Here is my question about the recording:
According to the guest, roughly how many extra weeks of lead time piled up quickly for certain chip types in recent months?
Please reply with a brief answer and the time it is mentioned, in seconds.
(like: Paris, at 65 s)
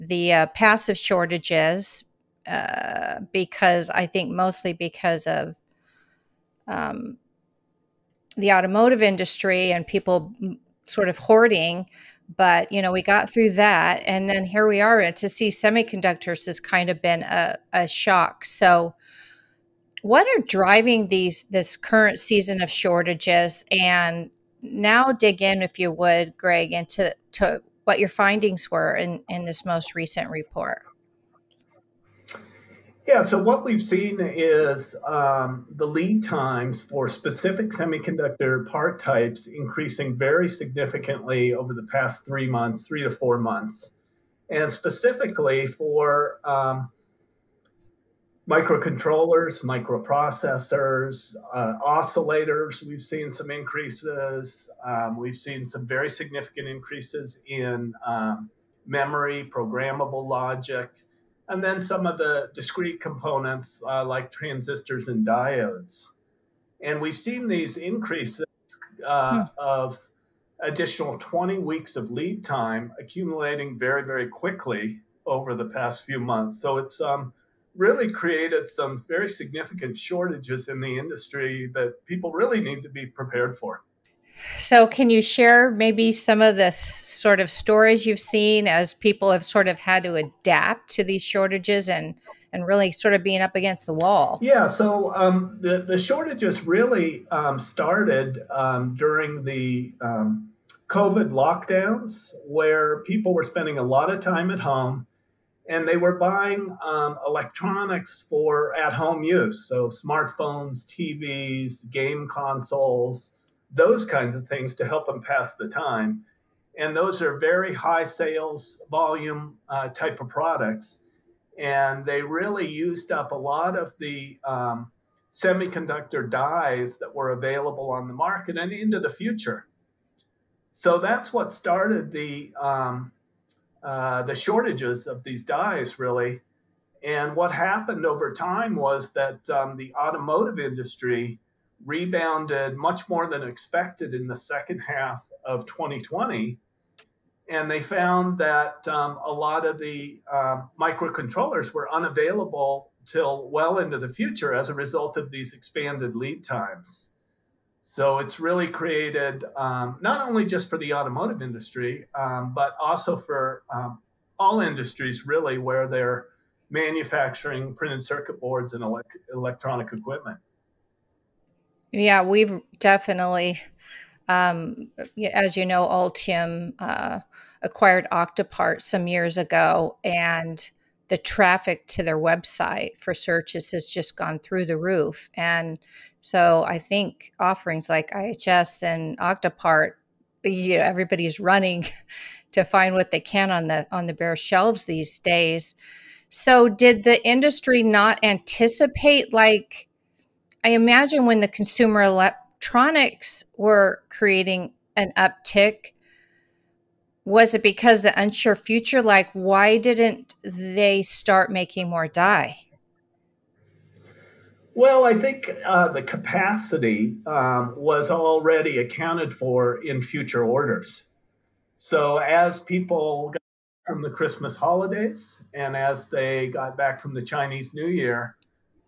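20 weeks, at 71 s.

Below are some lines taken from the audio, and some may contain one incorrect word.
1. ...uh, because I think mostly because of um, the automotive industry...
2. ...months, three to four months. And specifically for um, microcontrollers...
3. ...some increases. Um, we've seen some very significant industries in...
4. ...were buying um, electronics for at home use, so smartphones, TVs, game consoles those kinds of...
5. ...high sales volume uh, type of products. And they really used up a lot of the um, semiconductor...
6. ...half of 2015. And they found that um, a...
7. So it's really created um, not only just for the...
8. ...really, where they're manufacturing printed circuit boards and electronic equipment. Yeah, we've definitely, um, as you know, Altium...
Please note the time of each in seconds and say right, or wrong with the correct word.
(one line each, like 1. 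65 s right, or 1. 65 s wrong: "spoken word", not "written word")
1. 2 s right
2. 42 s right
3. 53 s wrong: "increases", not "industries"
4. 105 s right
5. 117 s right
6. 144 s wrong: "2020", not "2015"
7. 157 s right
8. 165 s right.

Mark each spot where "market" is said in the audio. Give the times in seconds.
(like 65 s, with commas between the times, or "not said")
128 s.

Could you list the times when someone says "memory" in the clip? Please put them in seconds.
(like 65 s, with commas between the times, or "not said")
58 s.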